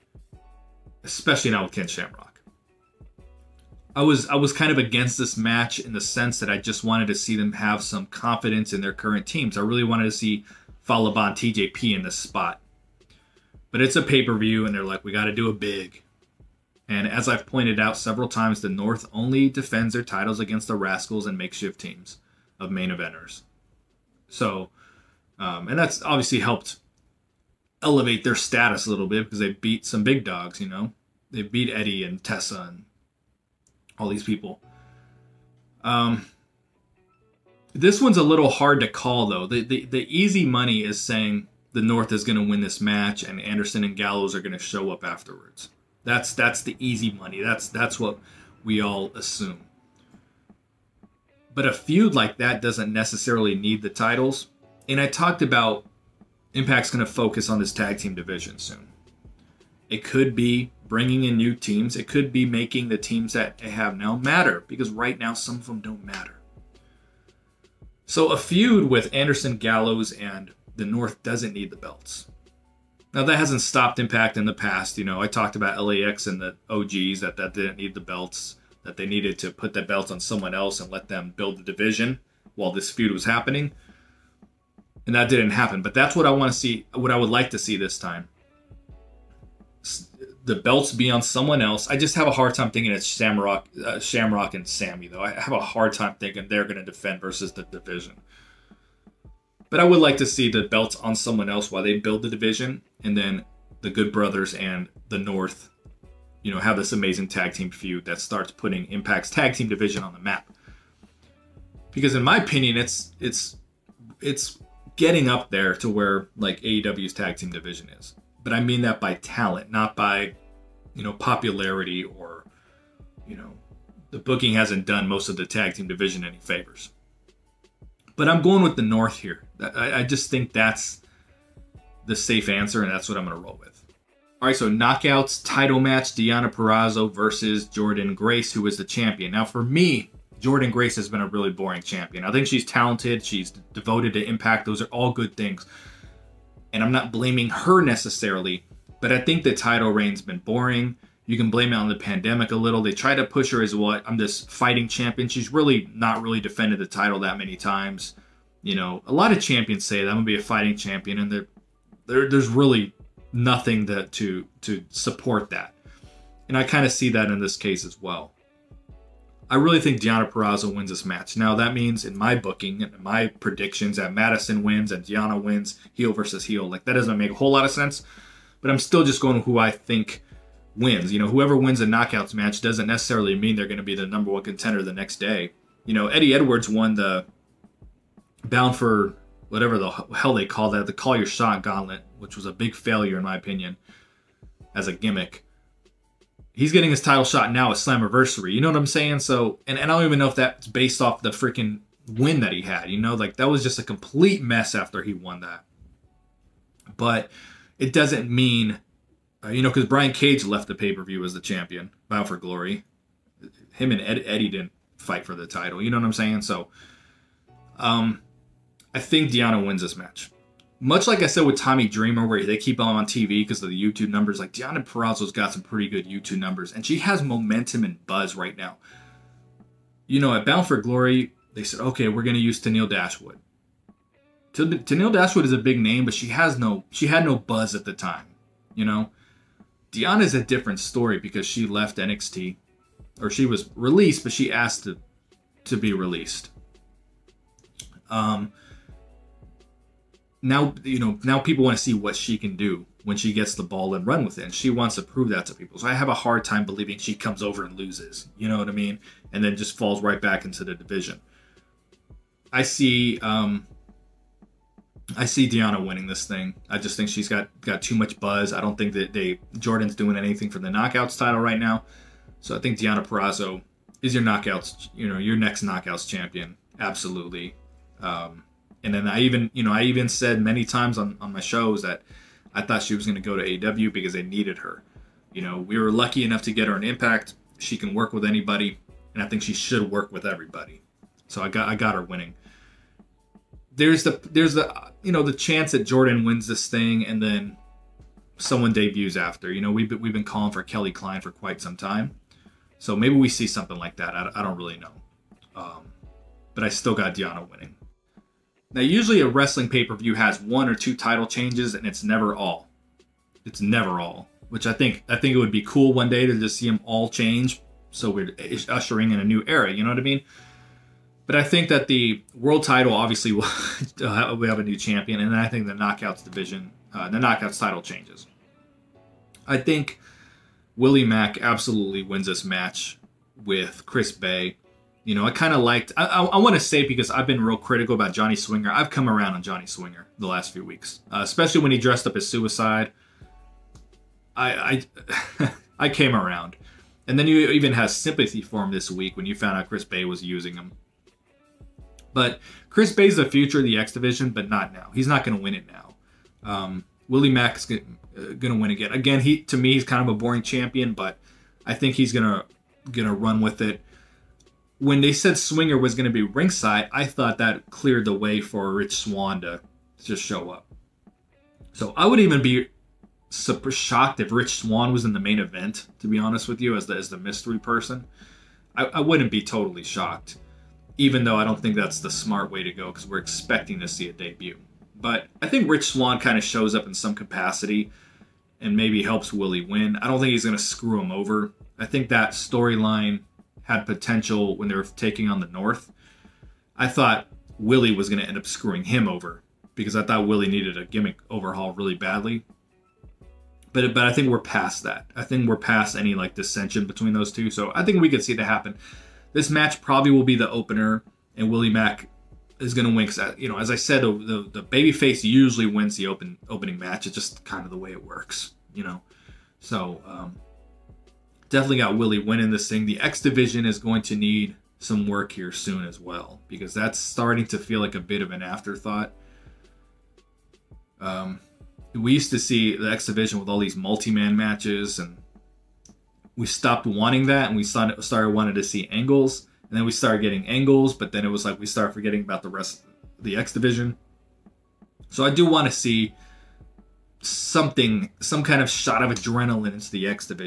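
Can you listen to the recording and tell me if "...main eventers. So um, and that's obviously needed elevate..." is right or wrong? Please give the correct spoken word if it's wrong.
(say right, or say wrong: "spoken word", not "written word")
wrong: "helped", not "needed".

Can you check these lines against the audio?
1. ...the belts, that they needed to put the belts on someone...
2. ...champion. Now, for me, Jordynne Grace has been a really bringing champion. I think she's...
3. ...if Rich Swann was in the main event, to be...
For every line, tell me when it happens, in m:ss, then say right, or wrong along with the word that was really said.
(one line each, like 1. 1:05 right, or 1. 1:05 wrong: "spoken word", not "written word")
1. 1:17 right
2. 2:18 wrong: "boring", not "bringing"
3. 6:14 right.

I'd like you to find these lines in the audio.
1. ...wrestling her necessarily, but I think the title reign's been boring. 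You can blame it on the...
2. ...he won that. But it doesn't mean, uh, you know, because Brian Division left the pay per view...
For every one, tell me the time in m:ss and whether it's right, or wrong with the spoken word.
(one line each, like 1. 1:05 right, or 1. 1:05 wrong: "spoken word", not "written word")
1. 2:27 wrong: "blaming", not "wrestling"
2. 3:25 wrong: "Cage", not "Division".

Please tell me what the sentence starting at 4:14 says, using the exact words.
And she wants to prove that to people.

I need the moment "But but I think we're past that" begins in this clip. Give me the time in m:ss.
6:43.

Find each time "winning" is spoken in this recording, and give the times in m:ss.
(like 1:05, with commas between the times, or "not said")
4:25, 4:52, 5:07, 7:02.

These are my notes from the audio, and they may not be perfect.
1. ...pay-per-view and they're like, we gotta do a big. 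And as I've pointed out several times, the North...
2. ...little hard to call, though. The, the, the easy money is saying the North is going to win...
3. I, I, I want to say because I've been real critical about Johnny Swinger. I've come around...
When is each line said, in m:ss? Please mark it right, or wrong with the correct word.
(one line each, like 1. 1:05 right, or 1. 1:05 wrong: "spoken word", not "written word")
1. 0:14 right
2. 0:38 right
3. 5:35 right.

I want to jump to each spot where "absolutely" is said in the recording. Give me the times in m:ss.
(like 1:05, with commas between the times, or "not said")
4:36, 5:31.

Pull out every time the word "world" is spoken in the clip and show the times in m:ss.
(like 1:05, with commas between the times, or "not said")
5:22.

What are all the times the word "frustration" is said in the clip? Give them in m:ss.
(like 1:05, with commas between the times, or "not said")
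not said.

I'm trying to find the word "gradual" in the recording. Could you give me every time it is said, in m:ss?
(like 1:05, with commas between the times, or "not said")
not said.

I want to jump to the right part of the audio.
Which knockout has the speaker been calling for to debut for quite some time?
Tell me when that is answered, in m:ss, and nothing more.
5:00.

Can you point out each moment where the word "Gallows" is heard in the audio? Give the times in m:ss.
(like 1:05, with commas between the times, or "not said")
0:43, 1:09.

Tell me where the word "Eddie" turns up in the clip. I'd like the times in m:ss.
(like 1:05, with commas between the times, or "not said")
0:31, 3:06, 3:34.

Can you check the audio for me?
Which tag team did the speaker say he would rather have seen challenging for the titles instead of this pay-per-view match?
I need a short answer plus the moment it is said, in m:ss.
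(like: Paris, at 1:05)
Fallah Bahh and TJP, at 0:10.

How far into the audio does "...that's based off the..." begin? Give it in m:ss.
3:20.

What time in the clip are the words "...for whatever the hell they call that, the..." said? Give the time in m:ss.
3:08.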